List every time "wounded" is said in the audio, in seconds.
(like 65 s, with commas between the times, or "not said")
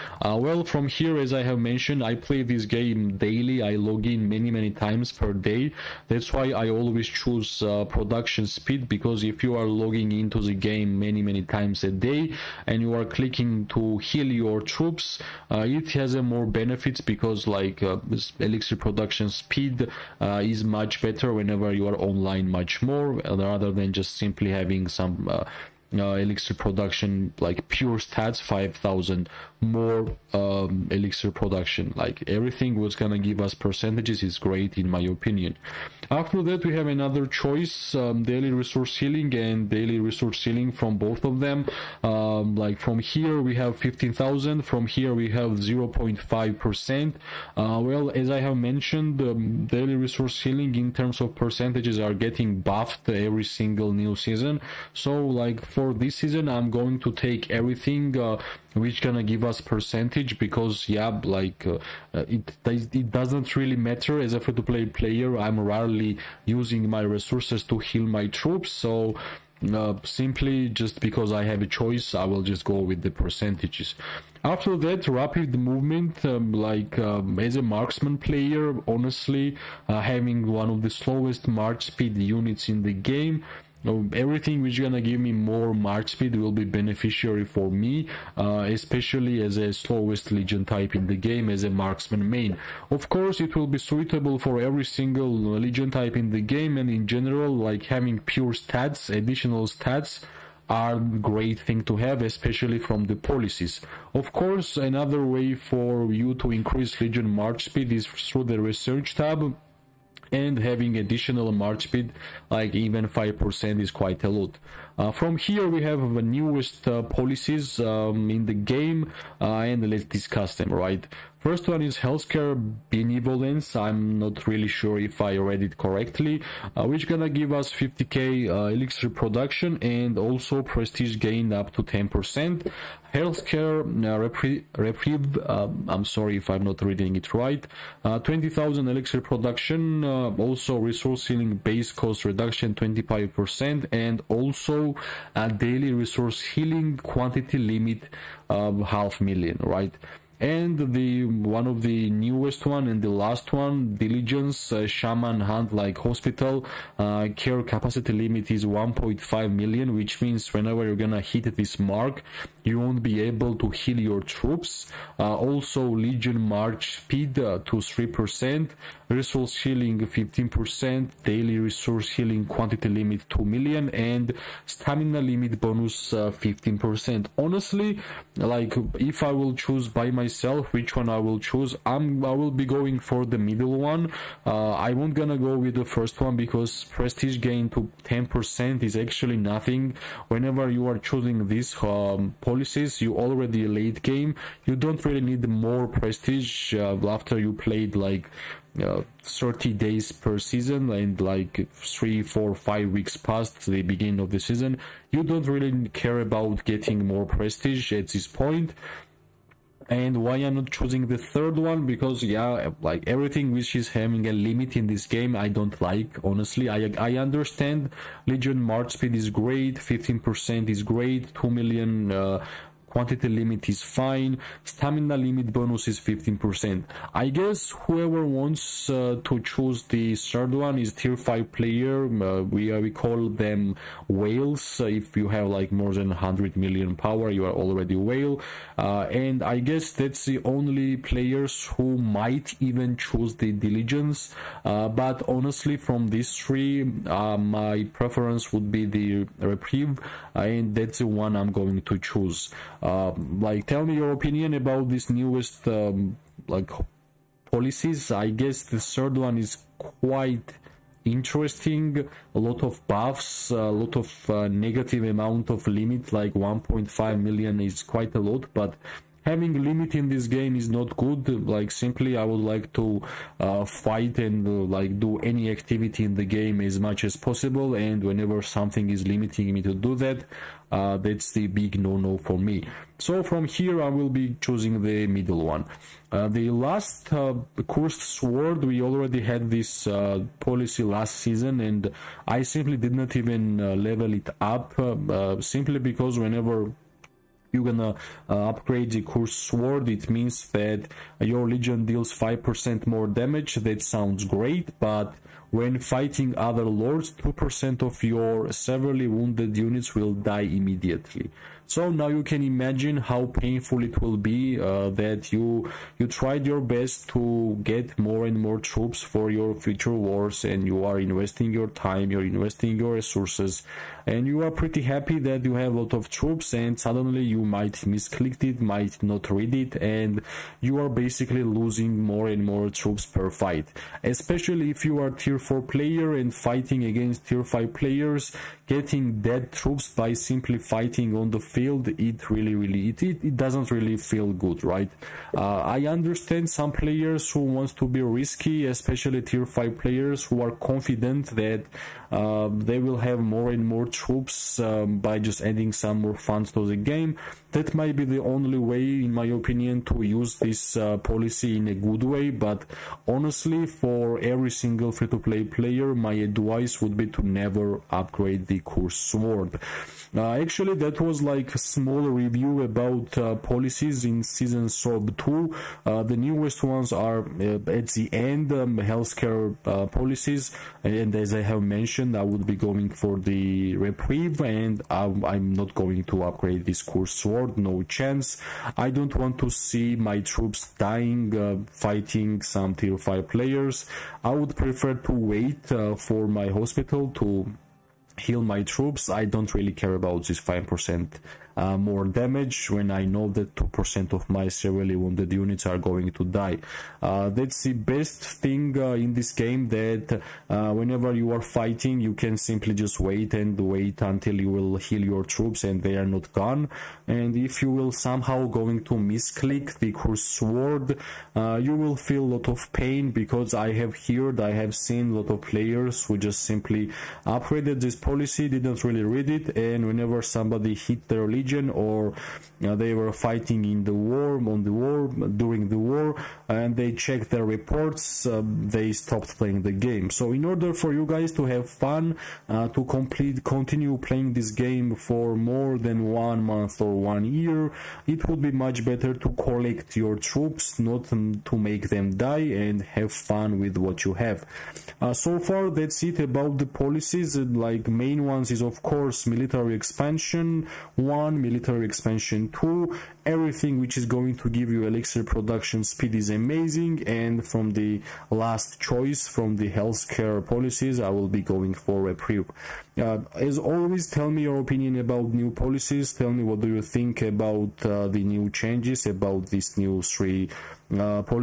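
309 s, 404 s.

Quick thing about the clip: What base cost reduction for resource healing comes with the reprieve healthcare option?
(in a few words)
25%.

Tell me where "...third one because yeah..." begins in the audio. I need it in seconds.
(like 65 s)
211 s.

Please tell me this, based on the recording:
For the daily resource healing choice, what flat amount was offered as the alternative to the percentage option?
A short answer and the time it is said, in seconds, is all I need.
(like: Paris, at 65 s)
15,000, at 43 s.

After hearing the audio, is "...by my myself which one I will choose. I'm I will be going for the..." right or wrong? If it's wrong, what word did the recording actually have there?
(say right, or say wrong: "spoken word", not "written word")
right.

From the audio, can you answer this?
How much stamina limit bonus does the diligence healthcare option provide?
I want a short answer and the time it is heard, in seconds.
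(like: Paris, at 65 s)
15%, at 174 s.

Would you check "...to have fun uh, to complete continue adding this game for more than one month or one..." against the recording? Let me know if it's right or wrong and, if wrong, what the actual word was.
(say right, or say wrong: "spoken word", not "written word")
wrong: "playing", not "adding".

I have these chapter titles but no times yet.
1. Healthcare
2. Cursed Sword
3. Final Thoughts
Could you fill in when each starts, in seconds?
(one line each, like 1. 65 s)
1. 114 s
2. 297 s
3. 437 s.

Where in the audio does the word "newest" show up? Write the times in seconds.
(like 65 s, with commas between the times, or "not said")
116 s, 152 s, 255 s, 376 s.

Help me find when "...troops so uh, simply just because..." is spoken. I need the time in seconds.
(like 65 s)
68 s.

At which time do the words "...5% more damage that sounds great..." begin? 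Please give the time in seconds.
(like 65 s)
302 s.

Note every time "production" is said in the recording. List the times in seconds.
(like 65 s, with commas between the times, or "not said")
7 s, 18 s, 26 s, 31 s, 129 s, 139 s, 465 s.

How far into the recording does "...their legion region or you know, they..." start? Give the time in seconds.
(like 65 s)
431 s.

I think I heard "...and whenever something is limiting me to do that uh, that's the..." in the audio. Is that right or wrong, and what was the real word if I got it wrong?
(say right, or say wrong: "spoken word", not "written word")
right.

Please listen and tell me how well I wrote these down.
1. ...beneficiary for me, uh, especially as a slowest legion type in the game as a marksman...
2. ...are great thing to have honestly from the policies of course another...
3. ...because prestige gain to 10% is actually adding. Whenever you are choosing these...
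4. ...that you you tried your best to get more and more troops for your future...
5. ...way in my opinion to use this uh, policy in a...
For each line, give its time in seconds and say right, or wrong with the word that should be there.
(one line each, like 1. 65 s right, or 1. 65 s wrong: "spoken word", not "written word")
1. 86 s right
2. 100 s wrong: "especially", not "honestly"
3. 186 s wrong: "nothing", not "adding"
4. 314 s right
5. 358 s right.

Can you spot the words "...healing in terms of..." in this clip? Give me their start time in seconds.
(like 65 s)
50 s.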